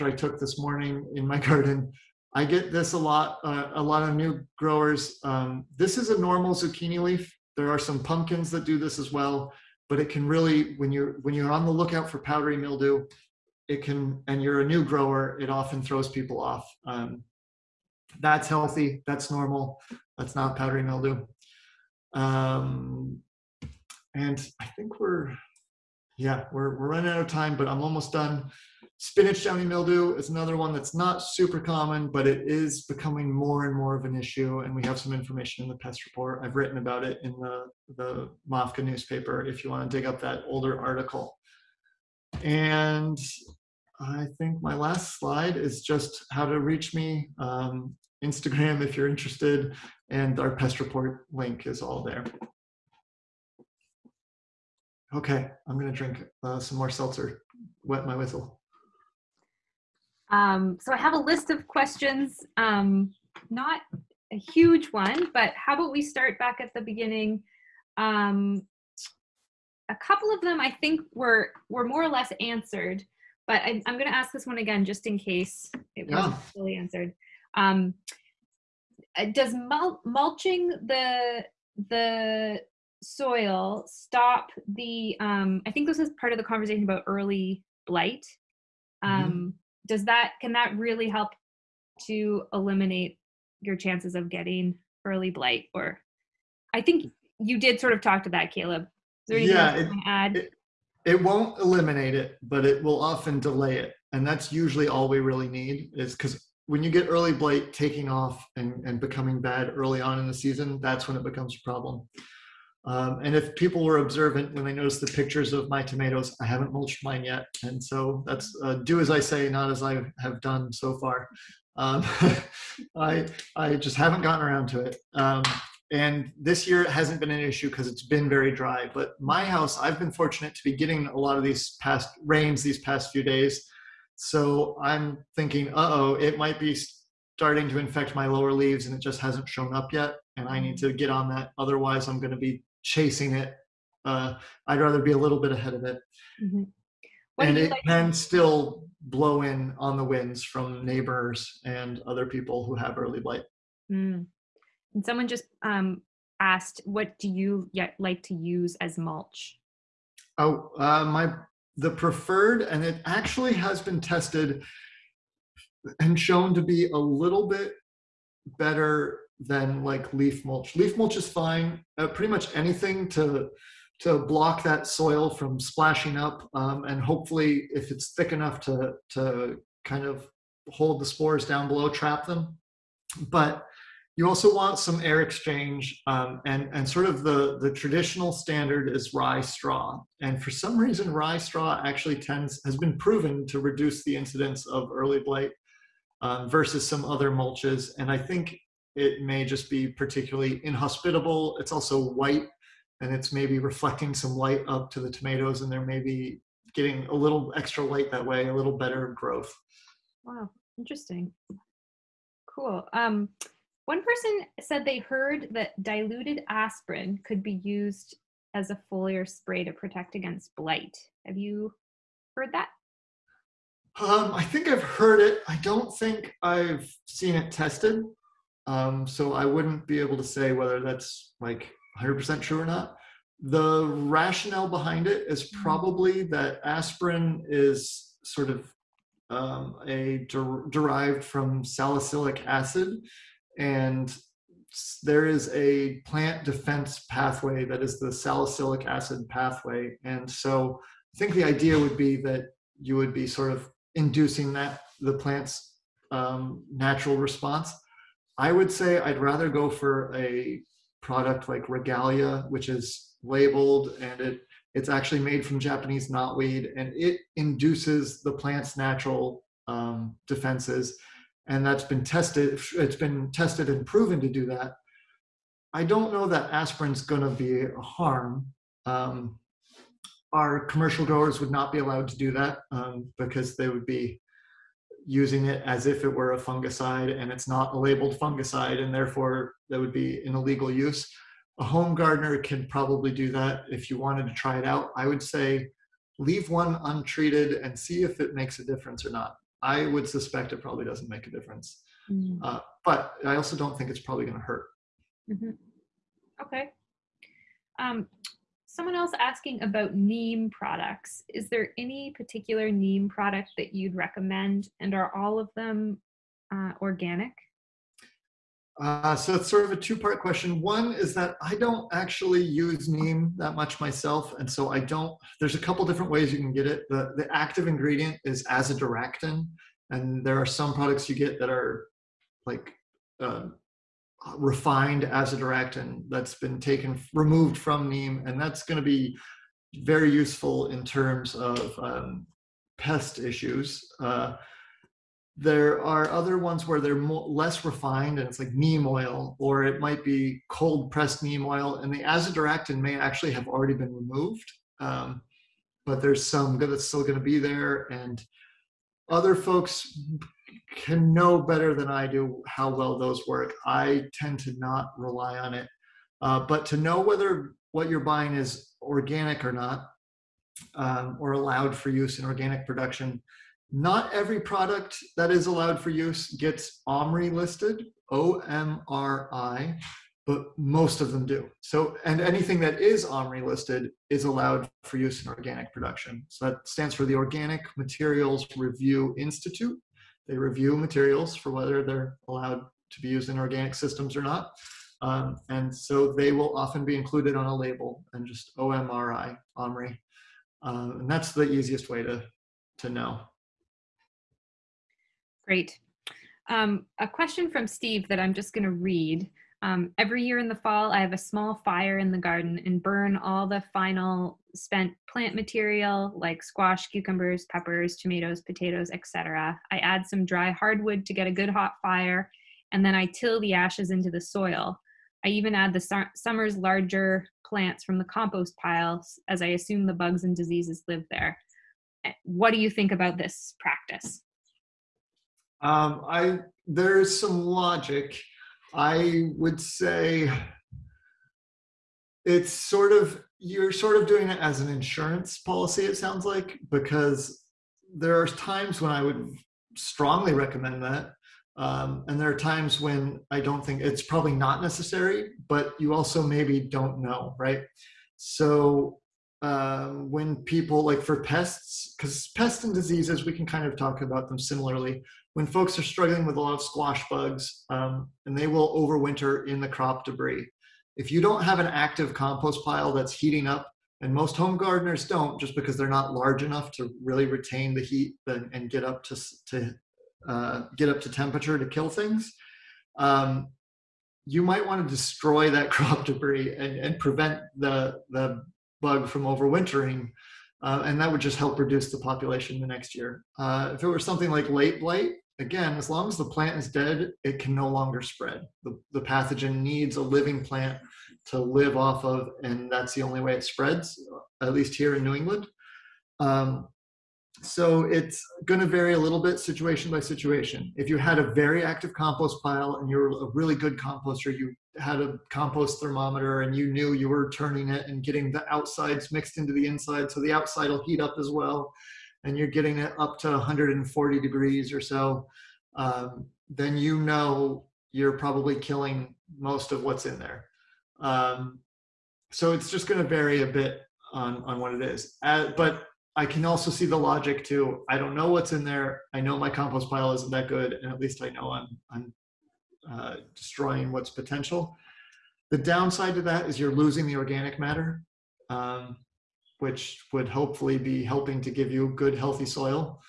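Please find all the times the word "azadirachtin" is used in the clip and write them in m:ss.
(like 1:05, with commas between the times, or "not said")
5:28, 5:35, 5:52.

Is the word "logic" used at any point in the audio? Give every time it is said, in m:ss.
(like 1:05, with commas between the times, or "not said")
7:17, 8:56.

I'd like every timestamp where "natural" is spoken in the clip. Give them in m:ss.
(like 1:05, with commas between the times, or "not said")
4:16, 4:28.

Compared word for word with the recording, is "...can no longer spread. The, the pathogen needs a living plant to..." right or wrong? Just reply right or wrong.
right.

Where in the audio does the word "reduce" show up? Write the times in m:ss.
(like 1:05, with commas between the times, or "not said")
3:13, 8:11.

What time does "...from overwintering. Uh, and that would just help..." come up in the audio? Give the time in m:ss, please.
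8:09.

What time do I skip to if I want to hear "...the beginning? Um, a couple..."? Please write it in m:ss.
1:06.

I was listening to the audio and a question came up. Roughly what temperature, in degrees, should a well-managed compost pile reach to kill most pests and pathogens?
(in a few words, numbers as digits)
140 degrees.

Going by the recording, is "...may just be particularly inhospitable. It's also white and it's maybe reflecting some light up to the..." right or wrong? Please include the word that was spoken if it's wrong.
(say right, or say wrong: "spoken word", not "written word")
right.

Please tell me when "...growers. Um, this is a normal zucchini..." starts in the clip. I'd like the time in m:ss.
0:04.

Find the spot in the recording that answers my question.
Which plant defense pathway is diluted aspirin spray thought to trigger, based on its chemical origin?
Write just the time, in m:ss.
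4:08.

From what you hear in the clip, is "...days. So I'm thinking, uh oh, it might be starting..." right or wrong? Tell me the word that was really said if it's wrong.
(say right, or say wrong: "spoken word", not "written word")
right.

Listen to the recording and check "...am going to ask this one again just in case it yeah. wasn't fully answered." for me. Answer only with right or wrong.
right.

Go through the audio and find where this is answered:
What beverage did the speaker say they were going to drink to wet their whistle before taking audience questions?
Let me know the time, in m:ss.
0:56.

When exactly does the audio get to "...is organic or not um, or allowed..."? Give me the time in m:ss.
6:08.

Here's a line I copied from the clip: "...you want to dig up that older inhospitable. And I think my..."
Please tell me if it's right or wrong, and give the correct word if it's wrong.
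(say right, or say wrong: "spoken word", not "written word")
wrong: "article", not "inhospitable".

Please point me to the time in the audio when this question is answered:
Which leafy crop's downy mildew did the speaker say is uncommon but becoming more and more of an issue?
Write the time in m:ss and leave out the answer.
0:28.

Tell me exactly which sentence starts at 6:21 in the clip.
So, and anything that is OMRI listed is allowed for use in organic production.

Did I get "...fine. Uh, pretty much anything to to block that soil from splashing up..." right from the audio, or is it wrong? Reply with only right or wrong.
right.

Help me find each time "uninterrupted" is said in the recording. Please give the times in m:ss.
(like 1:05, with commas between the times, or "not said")
not said.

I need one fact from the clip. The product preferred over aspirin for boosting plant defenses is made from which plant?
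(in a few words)
Japanese knotweed.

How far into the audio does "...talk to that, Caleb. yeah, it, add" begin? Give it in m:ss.
1:38.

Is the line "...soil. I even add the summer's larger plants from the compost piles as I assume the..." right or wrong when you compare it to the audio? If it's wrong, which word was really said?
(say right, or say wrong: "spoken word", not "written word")
right.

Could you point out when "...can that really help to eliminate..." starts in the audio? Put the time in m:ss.
1:30.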